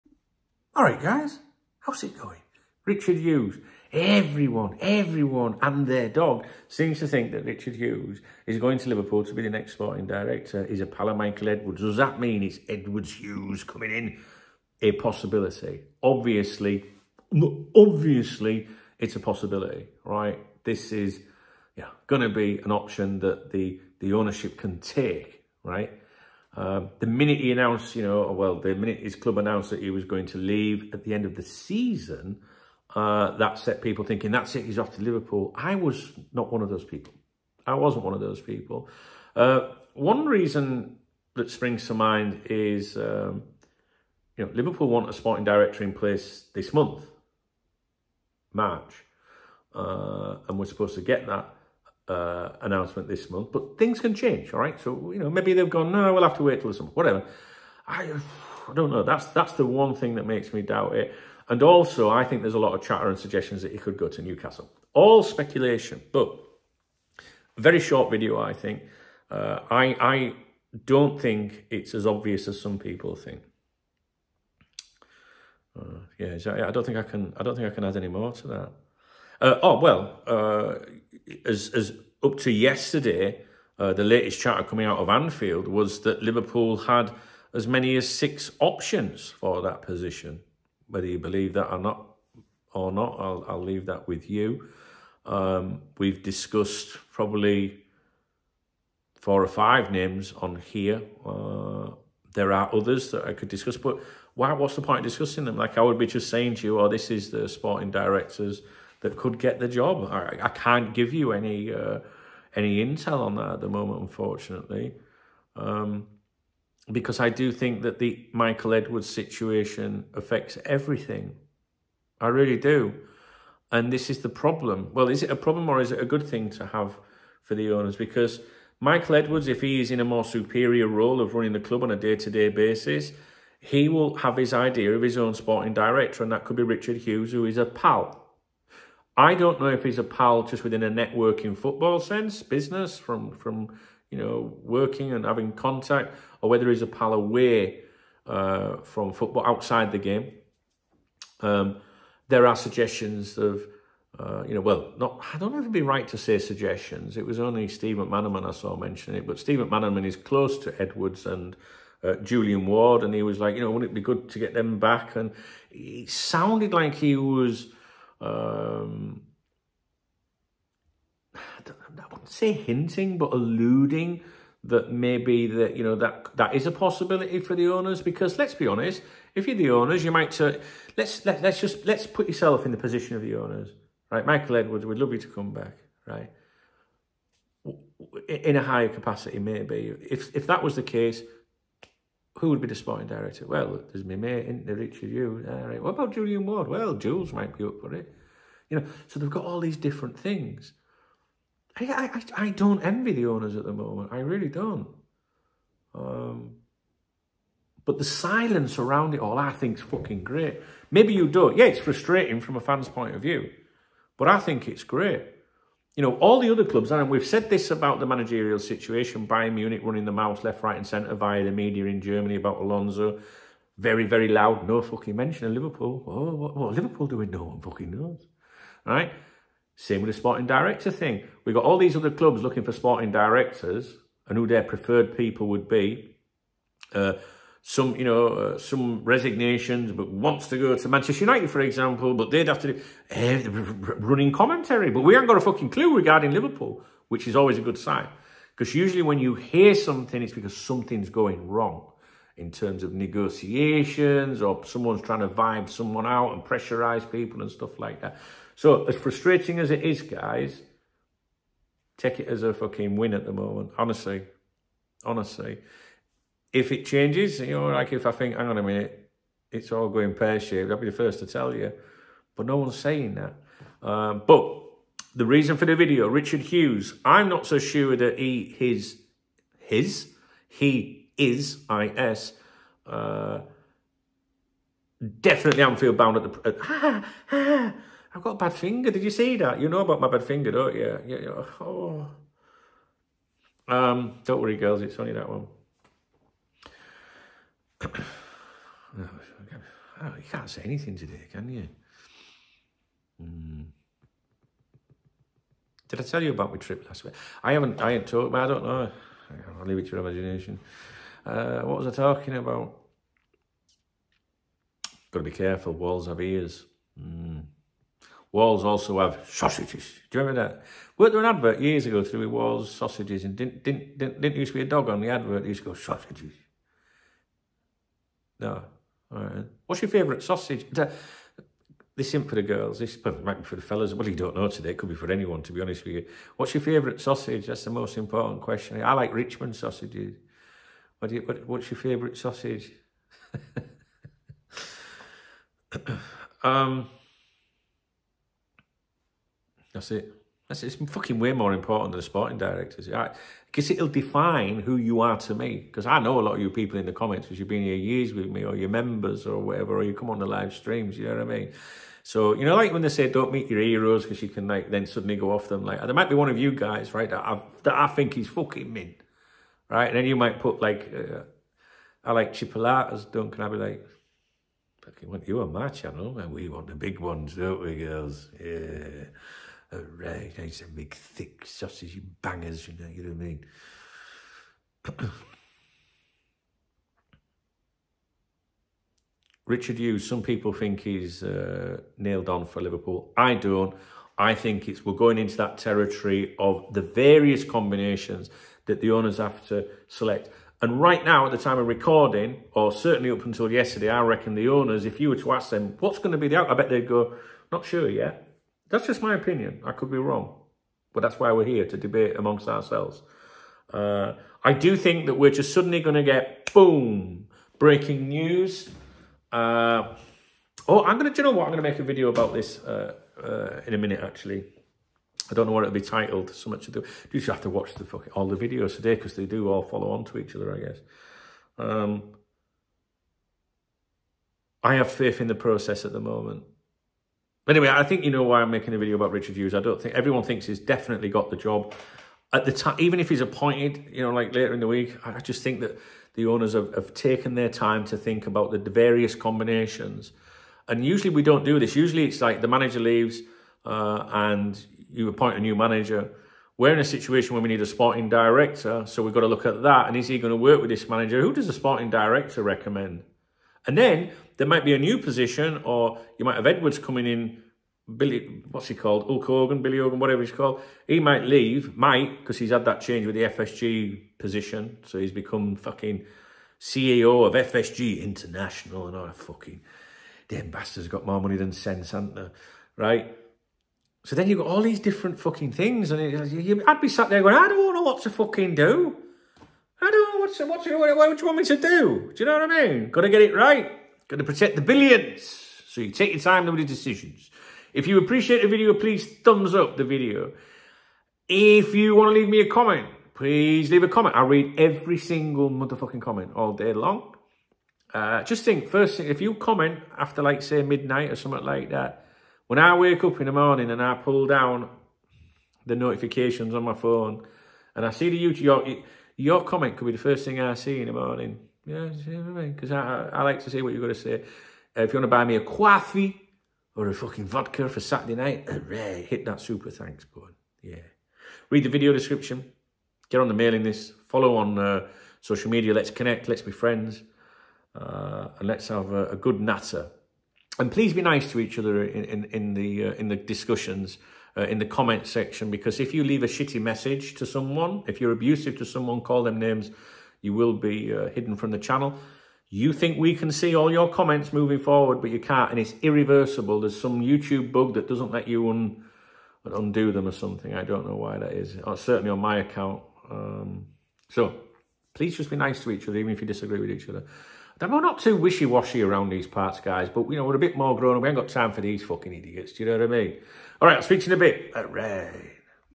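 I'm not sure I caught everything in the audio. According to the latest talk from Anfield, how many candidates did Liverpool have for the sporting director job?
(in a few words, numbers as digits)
6.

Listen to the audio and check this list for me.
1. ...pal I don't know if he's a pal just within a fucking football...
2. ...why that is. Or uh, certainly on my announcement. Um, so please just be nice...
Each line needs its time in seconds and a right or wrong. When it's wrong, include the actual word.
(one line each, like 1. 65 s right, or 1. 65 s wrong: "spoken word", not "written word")
1. 137 s wrong: "networking", not "fucking"
2. 560 s wrong: "account", not "announcement".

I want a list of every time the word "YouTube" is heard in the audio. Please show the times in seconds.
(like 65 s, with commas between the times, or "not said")
518 s, 557 s.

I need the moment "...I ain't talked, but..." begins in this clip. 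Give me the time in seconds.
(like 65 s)
307 s.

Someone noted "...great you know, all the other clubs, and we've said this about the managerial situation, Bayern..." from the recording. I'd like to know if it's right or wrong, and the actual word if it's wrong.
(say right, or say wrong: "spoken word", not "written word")
right.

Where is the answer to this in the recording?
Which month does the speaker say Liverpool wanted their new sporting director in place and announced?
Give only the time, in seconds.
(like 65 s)
48 s.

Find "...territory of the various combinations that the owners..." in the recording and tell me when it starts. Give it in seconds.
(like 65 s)
395 s.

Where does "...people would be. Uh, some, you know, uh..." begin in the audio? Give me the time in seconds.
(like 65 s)
235 s.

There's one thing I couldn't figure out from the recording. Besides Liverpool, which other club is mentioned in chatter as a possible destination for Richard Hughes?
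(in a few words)
Newcastle.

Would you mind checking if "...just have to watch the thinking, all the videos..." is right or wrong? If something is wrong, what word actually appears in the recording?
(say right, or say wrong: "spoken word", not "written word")
wrong: "fucking", not "thinking".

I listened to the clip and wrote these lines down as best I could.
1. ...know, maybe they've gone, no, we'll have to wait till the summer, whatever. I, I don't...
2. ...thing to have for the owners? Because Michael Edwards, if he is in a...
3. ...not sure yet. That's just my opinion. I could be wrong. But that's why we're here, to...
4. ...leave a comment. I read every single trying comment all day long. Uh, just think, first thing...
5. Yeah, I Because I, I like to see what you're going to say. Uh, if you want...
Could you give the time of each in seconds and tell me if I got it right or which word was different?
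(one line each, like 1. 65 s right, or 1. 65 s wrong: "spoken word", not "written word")
1. 55 s right
2. 126 s right
3. 407 s right
4. 503 s wrong: "motherfucking", not "trying"
5. 521 s right.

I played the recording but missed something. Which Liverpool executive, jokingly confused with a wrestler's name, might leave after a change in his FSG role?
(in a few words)
Billy Hogan.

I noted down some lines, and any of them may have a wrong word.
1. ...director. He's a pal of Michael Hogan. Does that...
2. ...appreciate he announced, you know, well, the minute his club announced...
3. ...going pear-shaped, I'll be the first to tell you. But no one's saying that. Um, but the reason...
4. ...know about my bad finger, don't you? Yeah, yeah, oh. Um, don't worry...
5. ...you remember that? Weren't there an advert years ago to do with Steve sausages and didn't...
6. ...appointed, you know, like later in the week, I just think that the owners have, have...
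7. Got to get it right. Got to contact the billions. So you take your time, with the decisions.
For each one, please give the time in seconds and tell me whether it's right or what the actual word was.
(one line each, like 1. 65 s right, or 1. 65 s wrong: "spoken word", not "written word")
1. 10 s wrong: "Edwards", not "Hogan"
2. 27 s wrong: "minute", not "appreciate"
3. 269 s right
4. 289 s right
5. 320 s wrong: "Walls", not "Steve"
6. 443 s right
7. 492 s wrong: "protect", not "contact".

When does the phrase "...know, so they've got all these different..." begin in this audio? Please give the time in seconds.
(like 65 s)
198 s.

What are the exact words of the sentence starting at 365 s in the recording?
Like there might be one of you guys, right, that, i that I think he's fucking mean, right?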